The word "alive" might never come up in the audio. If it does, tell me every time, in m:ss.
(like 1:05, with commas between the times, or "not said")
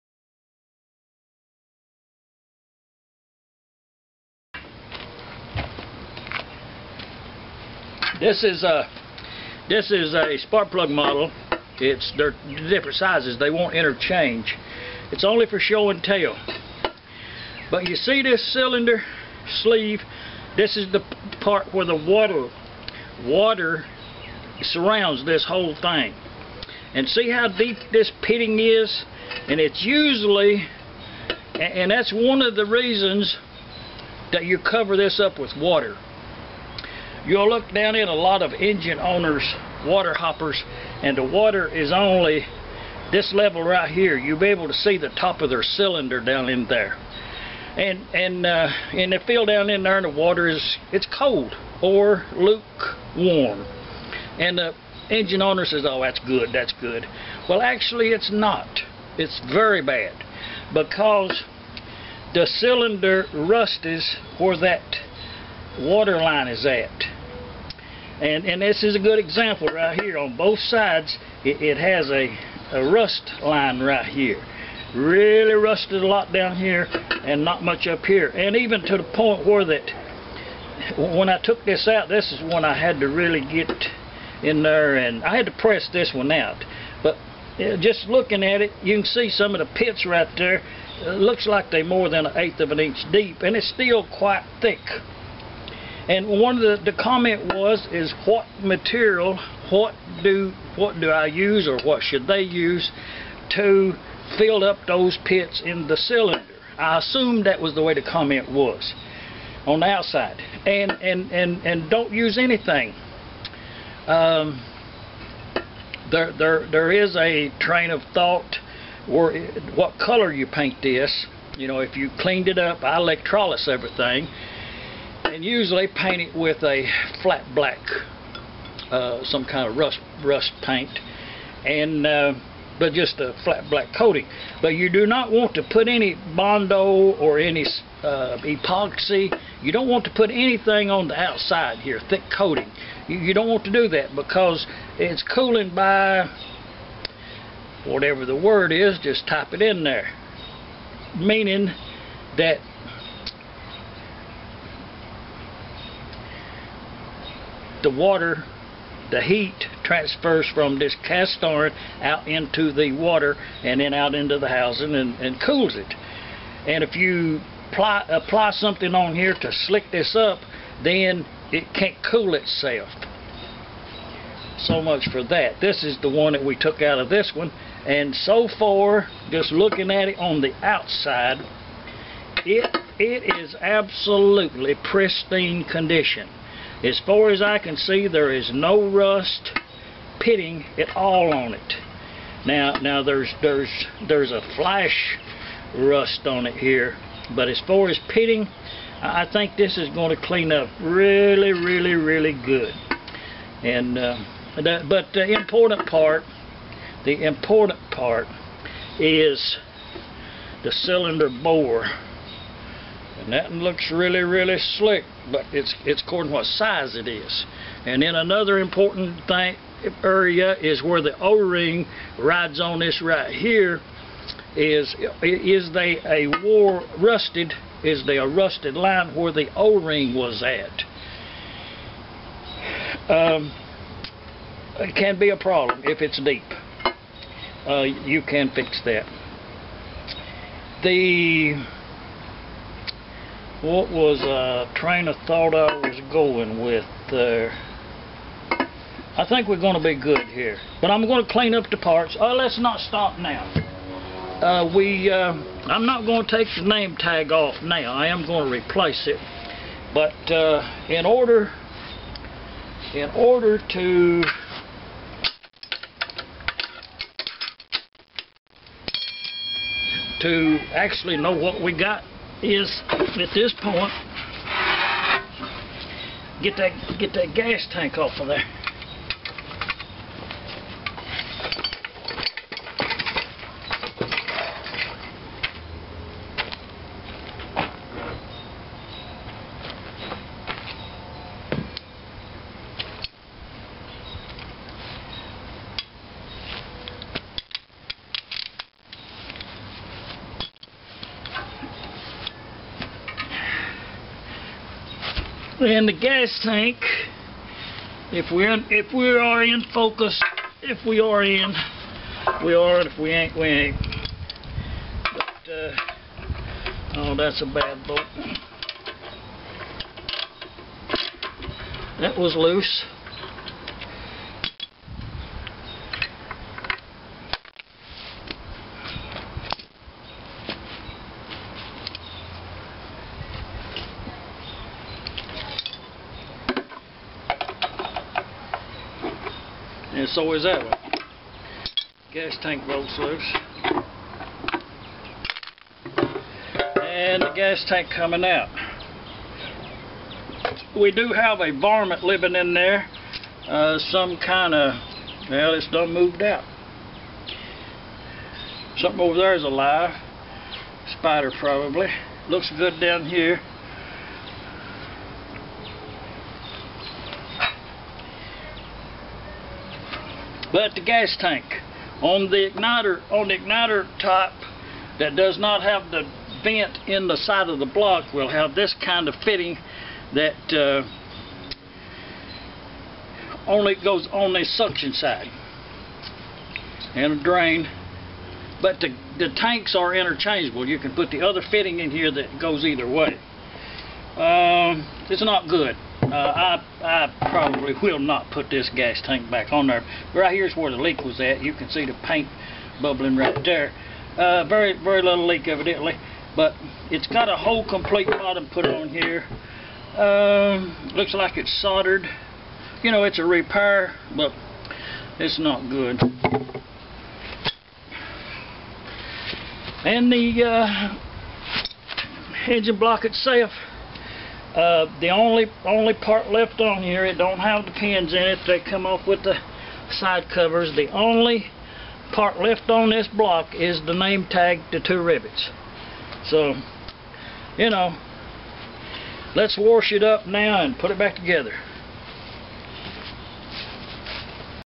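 5:59.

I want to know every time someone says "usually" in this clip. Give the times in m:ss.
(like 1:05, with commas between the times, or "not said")
0:29, 2:05.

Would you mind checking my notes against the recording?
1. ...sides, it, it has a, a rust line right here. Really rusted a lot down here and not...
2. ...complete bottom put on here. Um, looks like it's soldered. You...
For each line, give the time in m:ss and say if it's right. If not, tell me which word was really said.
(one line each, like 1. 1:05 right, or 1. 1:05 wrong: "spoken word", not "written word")
1. 1:10 right
2. 6:47 right.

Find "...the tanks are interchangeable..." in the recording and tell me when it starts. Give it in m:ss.
6:29.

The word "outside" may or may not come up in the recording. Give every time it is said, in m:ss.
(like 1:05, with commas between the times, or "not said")
1:49, 2:21, 3:00.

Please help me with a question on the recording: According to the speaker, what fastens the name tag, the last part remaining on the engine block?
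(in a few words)
two rivets.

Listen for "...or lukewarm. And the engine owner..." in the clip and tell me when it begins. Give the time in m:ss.
0:51.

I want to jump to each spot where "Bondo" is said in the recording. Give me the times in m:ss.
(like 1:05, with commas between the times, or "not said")
2:16.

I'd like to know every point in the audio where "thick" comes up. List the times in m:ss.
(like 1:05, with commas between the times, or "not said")
1:34, 2:22.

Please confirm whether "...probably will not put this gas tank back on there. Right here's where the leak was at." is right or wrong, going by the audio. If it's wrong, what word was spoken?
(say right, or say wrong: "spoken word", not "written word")
right.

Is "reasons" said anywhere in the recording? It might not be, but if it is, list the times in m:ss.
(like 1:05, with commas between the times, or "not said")
0:32.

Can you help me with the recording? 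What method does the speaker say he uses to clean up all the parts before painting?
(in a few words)
electrolysis.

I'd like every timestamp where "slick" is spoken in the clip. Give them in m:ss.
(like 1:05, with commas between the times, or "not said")
2:49, 3:34.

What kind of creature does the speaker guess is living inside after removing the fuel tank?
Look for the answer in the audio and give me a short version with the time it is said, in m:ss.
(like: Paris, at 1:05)
Spider, at 6:00.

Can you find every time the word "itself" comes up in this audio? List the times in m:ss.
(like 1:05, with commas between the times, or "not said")
2:52, 7:03.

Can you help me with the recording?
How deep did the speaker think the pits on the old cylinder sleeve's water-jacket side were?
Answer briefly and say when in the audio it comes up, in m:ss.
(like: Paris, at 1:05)
more than 1/8 inch, at 1:31.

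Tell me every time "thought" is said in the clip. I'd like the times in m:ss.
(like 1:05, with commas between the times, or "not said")
1:58, 4:05.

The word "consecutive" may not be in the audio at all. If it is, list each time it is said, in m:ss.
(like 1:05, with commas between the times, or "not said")
not said.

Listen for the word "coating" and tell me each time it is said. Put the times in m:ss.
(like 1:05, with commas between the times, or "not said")
2:13, 2:22.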